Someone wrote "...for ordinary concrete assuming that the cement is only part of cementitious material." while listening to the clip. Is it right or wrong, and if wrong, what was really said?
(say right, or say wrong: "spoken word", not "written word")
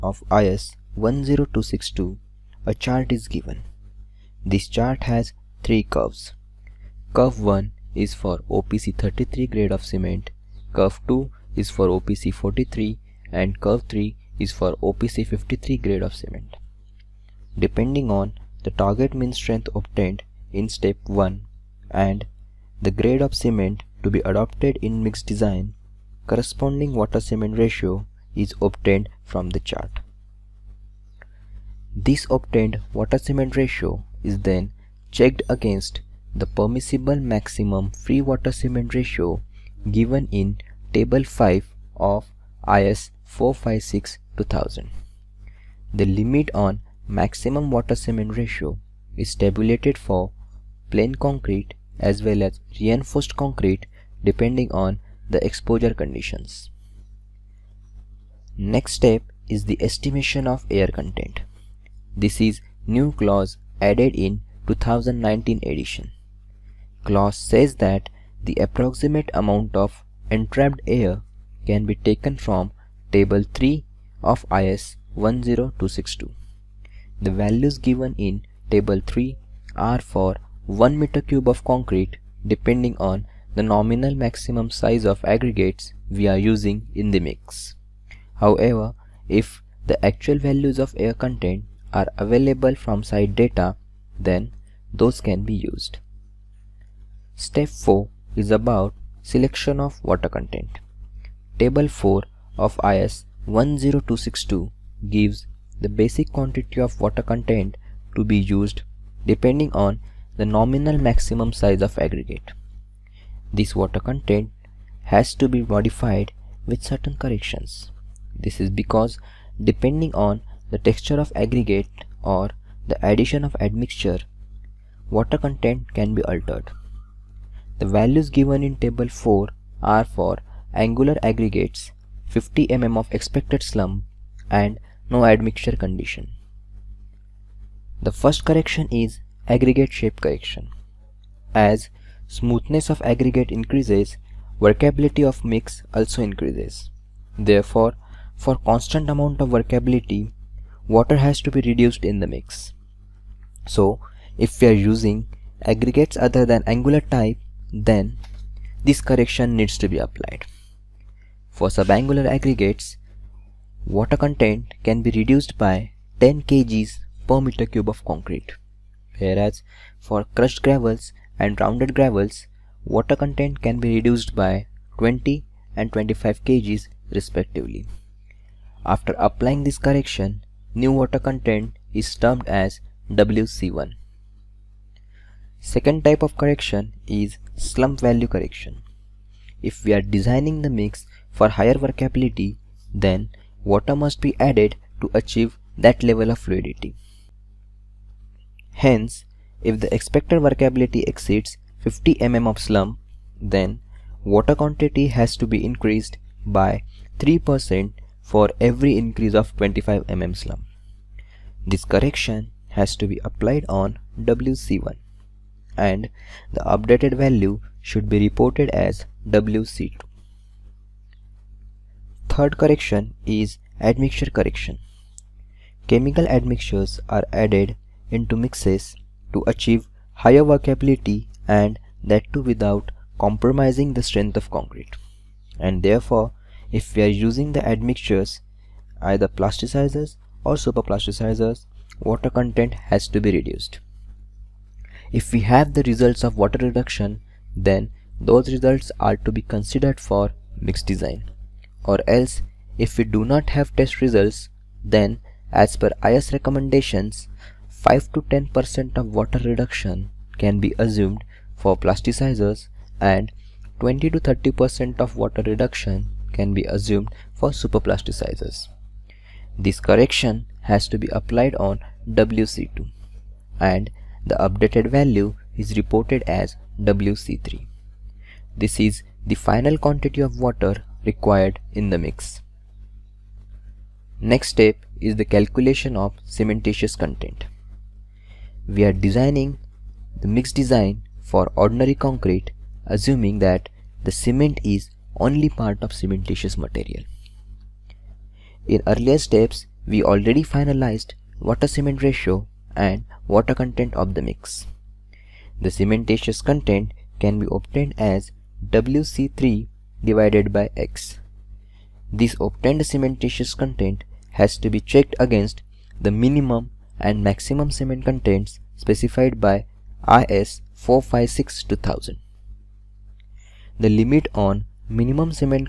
right.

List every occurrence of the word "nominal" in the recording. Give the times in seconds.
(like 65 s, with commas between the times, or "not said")
83 s, 110 s.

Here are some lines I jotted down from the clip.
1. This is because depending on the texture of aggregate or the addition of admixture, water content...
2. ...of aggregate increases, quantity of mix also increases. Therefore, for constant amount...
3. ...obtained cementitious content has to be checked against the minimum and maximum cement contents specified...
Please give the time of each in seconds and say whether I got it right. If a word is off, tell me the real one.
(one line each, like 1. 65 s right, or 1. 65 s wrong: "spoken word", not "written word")
1. 118 s right
2. 142 s wrong: "workability", not "quantity"
3. 312 s right.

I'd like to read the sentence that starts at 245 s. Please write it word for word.
If we have the results of water reduction, then those results are to be considered for mix design.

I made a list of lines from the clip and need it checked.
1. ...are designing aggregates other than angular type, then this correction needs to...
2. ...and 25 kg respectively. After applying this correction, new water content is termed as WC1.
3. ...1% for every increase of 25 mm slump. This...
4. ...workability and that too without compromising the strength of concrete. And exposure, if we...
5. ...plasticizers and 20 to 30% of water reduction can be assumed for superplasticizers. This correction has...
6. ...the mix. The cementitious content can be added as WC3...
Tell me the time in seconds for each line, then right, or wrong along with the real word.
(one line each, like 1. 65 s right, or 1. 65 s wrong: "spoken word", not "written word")
1. 154 s wrong: "using", not "designing"
2. 175 s right
3. 207 s wrong: "3", not "1"
4. 230 s wrong: "therefore", not "exposure"
5. 261 s right
6. 304 s wrong: "obtained", not "added".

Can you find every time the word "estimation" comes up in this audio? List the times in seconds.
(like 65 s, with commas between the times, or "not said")
59 s.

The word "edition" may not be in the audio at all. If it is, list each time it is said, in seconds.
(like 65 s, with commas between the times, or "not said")
65 s.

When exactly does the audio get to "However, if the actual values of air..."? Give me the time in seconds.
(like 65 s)
88 s.